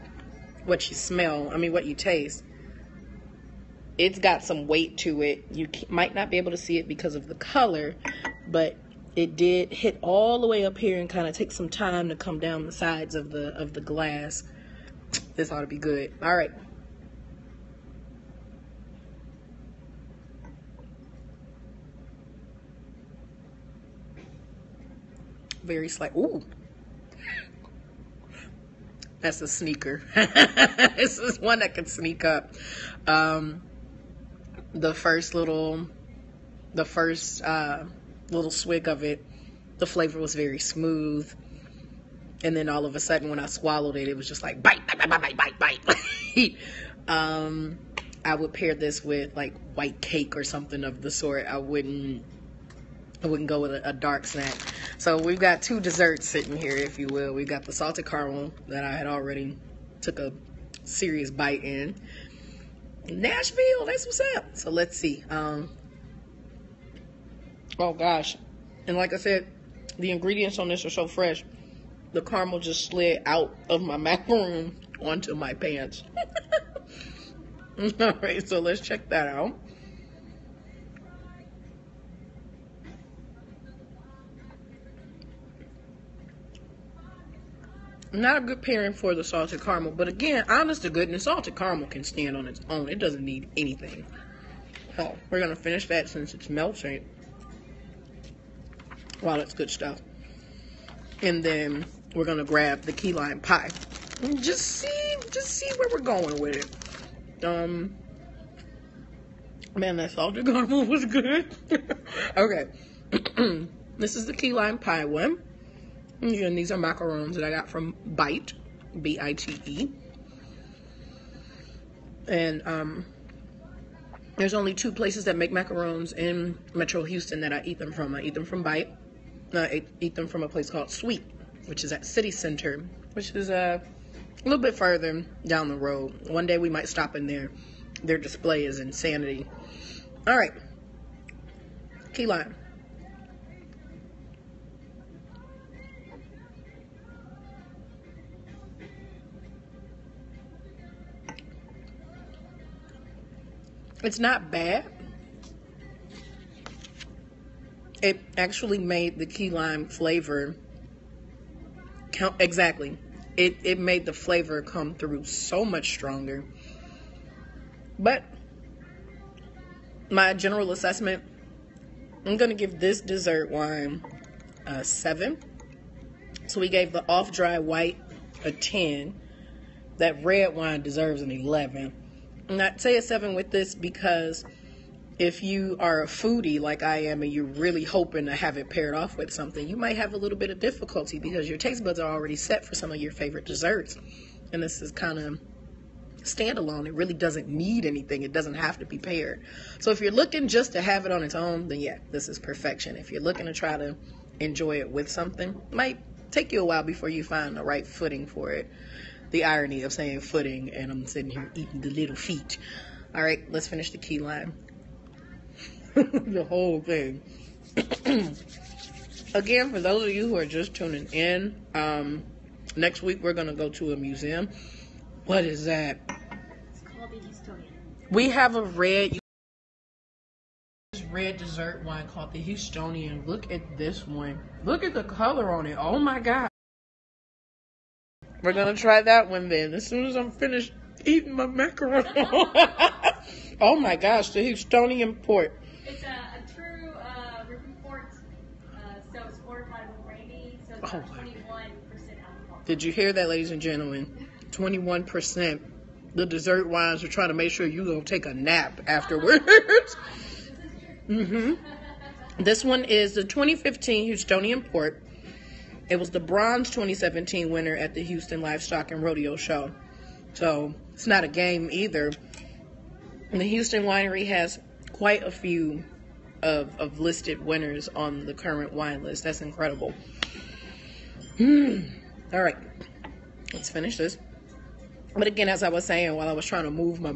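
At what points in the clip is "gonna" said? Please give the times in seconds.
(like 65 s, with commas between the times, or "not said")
95 s, 102 s, 172 s, 238 s.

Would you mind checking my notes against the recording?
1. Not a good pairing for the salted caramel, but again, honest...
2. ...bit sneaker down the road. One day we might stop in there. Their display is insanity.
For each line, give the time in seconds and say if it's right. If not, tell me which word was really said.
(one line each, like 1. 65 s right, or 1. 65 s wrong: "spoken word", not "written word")
1. 88 s right
2. 134 s wrong: "further", not "sneaker".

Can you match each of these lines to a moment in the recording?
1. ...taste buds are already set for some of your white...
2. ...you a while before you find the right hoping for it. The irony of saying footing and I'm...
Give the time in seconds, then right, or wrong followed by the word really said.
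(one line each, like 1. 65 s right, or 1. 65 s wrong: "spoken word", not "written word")
1. 191 s wrong: "favorite", not "white"
2. 206 s wrong: "footing", not "hoping".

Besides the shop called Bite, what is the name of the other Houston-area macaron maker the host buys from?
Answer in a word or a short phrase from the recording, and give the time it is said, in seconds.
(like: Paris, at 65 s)
Sweet, at 130 s.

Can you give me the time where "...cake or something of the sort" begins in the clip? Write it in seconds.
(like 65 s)
50 s.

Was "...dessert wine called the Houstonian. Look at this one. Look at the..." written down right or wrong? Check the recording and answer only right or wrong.
right.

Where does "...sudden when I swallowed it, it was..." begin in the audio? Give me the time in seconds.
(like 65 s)
42 s.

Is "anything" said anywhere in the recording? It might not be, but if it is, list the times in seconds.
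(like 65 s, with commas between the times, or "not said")
93 s, 197 s.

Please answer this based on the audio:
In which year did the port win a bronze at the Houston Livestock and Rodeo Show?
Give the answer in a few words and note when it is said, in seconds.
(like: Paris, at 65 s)
2017, at 266 s.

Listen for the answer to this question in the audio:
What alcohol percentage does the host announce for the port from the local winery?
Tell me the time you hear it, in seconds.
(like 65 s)
250 s.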